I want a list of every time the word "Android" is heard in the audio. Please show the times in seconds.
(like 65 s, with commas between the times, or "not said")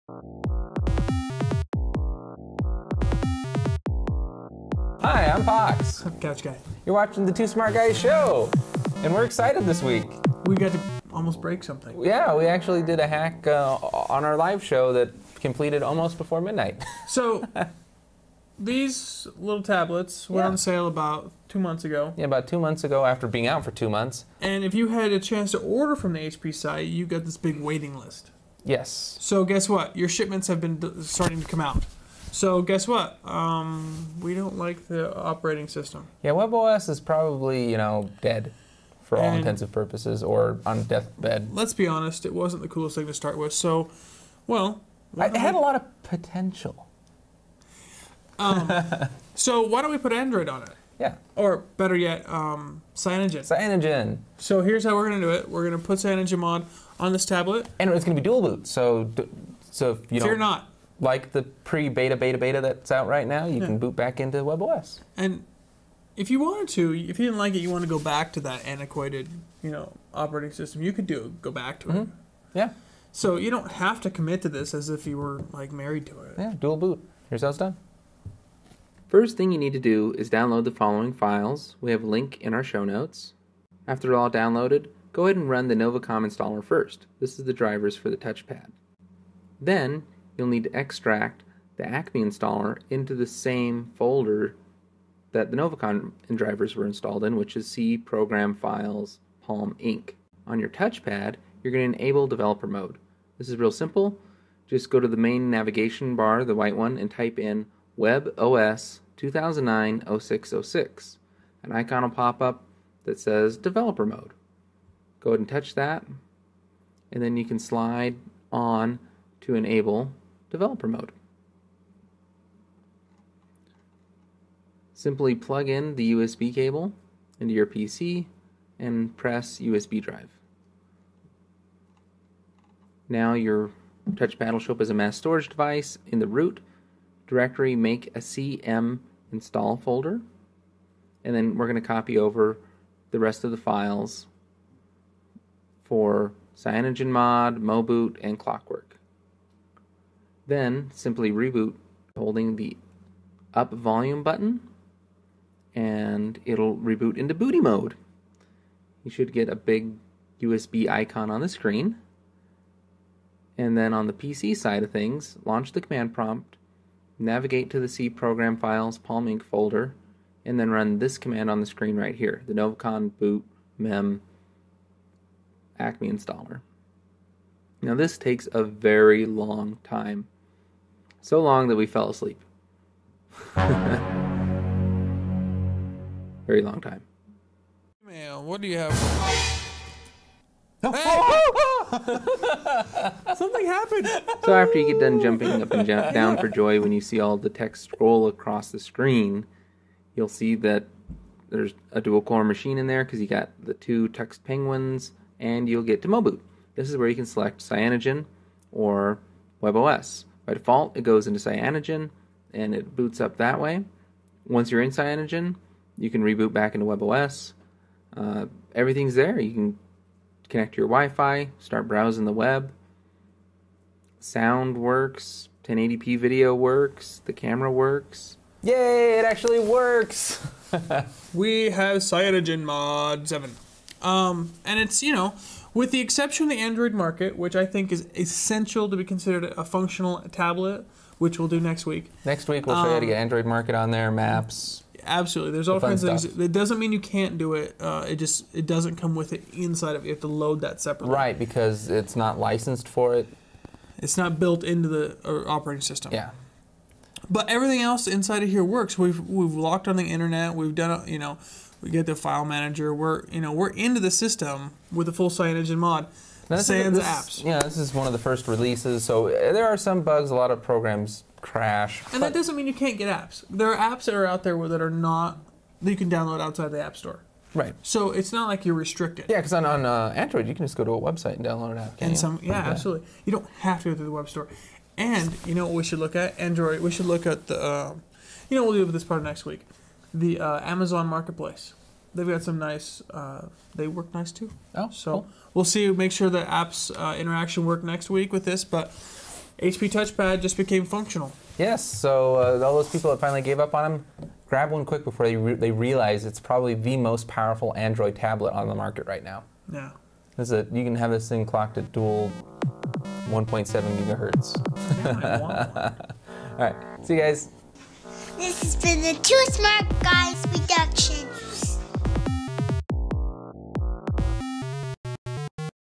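50 s, 236 s, 243 s, 280 s, 286 s, 307 s.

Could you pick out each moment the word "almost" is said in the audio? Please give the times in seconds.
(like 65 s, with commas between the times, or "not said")
11 s, 15 s.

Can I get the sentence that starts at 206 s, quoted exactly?
This is where you can select Cyanogen or WebOS.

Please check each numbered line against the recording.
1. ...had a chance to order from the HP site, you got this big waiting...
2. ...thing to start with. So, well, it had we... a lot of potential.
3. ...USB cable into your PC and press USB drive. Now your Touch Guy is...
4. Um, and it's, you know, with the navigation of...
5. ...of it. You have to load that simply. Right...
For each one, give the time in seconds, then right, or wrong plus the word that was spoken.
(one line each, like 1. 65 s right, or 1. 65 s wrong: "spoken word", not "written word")
1. 24 s right
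2. 42 s right
3. 126 s wrong: "Battleship", not "Guy"
4. 234 s wrong: "exception", not "navigation"
5. 249 s wrong: "separately", not "simply".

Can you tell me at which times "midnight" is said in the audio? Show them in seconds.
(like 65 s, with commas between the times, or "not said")
16 s.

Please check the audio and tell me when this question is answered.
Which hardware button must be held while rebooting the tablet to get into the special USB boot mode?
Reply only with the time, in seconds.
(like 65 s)
153 s.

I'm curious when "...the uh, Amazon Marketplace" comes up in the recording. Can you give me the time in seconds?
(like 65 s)
290 s.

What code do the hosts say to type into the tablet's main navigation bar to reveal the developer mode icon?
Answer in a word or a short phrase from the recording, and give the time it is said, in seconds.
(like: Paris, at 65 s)
WebOS 2009-0606, at 107 s.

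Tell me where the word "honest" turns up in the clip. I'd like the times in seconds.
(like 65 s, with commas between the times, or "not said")
41 s.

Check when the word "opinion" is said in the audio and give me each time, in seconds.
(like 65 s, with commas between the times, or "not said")
not said.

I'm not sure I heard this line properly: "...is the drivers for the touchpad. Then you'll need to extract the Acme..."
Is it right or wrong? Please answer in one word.
right.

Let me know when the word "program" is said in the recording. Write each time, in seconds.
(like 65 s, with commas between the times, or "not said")
97 s, 168 s, 270 s.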